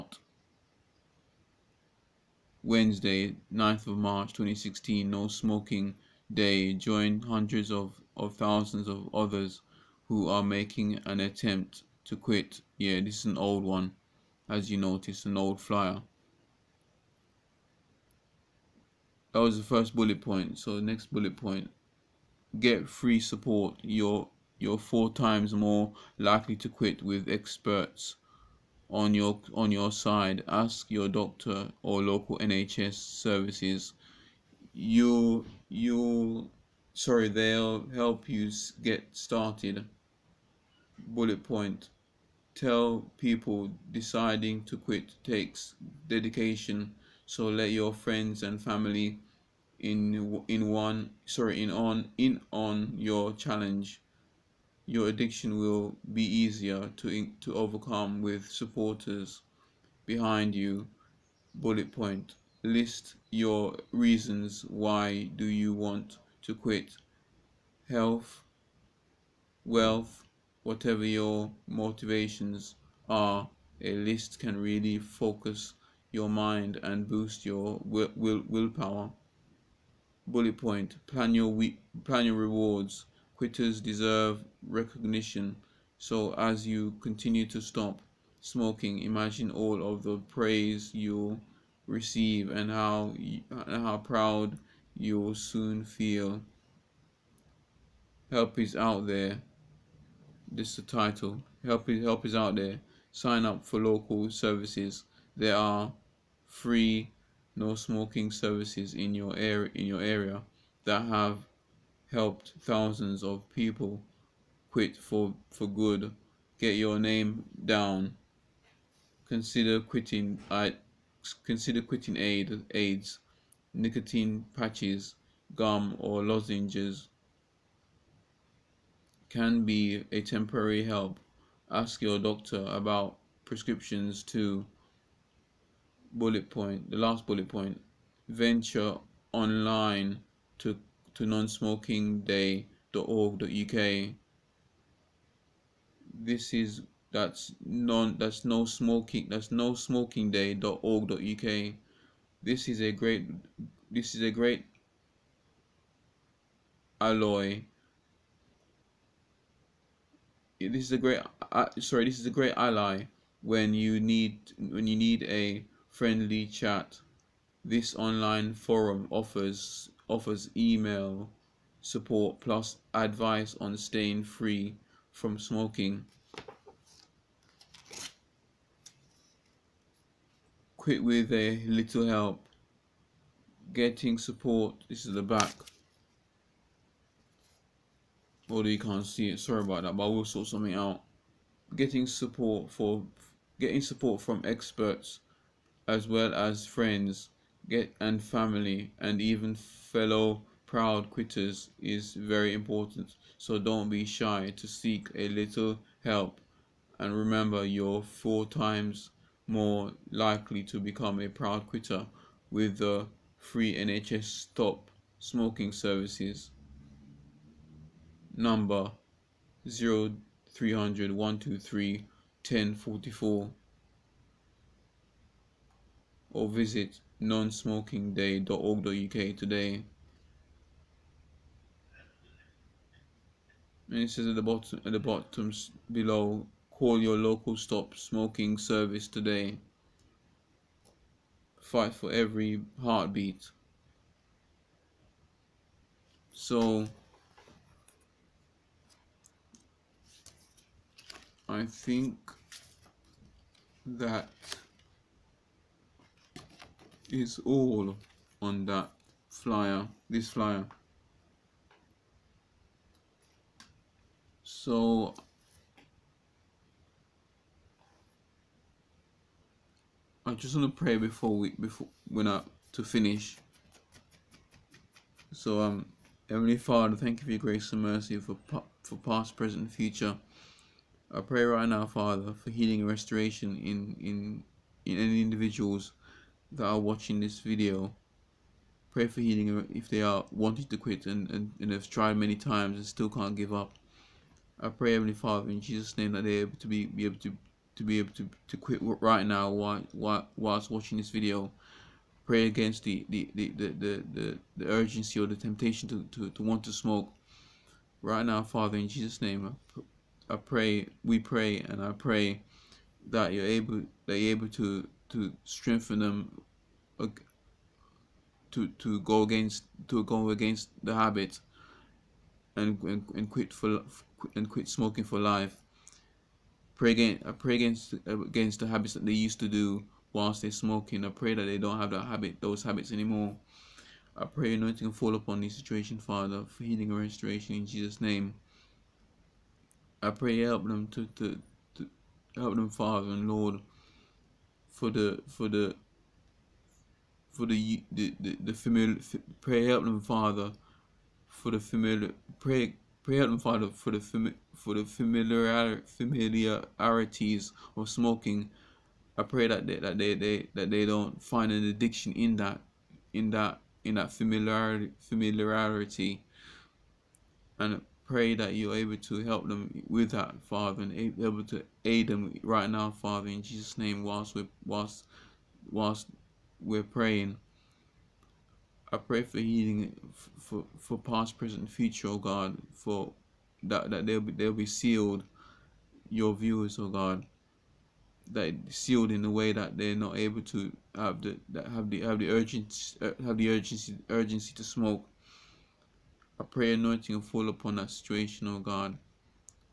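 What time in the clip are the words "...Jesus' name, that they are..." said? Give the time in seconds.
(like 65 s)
295 s.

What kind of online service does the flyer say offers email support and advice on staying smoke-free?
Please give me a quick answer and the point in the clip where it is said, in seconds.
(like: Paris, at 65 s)
Online forum, at 167 s.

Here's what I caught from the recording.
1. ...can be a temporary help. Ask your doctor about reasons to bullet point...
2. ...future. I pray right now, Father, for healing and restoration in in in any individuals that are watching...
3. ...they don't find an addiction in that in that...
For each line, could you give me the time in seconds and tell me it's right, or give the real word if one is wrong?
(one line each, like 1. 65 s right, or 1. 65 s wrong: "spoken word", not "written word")
1. 129 s wrong: "prescriptions", not "reasons"
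2. 279 s right
3. 360 s right.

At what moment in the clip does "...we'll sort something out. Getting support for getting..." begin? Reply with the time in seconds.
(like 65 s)
190 s.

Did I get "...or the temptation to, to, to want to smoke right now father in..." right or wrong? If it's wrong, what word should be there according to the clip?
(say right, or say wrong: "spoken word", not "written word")
right.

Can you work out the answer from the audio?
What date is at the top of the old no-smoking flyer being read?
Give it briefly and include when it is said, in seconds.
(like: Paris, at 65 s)
Wednesday 9th March 2016, at 2 s.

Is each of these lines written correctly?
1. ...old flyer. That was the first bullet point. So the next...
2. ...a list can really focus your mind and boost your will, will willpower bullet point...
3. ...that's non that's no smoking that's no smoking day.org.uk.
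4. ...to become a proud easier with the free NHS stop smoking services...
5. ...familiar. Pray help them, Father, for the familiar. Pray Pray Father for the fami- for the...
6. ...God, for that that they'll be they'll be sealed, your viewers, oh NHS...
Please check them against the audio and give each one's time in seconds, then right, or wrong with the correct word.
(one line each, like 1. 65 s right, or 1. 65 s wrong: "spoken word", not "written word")
1. 15 s right
2. 73 s right
3. 147 s right
4. 210 s wrong: "quitter", not "easier"
5. 348 s right
6. 382 s wrong: "God", not "NHS".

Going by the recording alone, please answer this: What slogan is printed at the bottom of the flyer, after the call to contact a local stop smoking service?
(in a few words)
Fight for every heartbeat.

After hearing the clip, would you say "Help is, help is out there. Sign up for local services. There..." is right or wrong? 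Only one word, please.
right.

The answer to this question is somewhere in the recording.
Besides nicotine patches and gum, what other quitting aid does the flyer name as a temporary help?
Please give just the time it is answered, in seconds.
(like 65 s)
126 s.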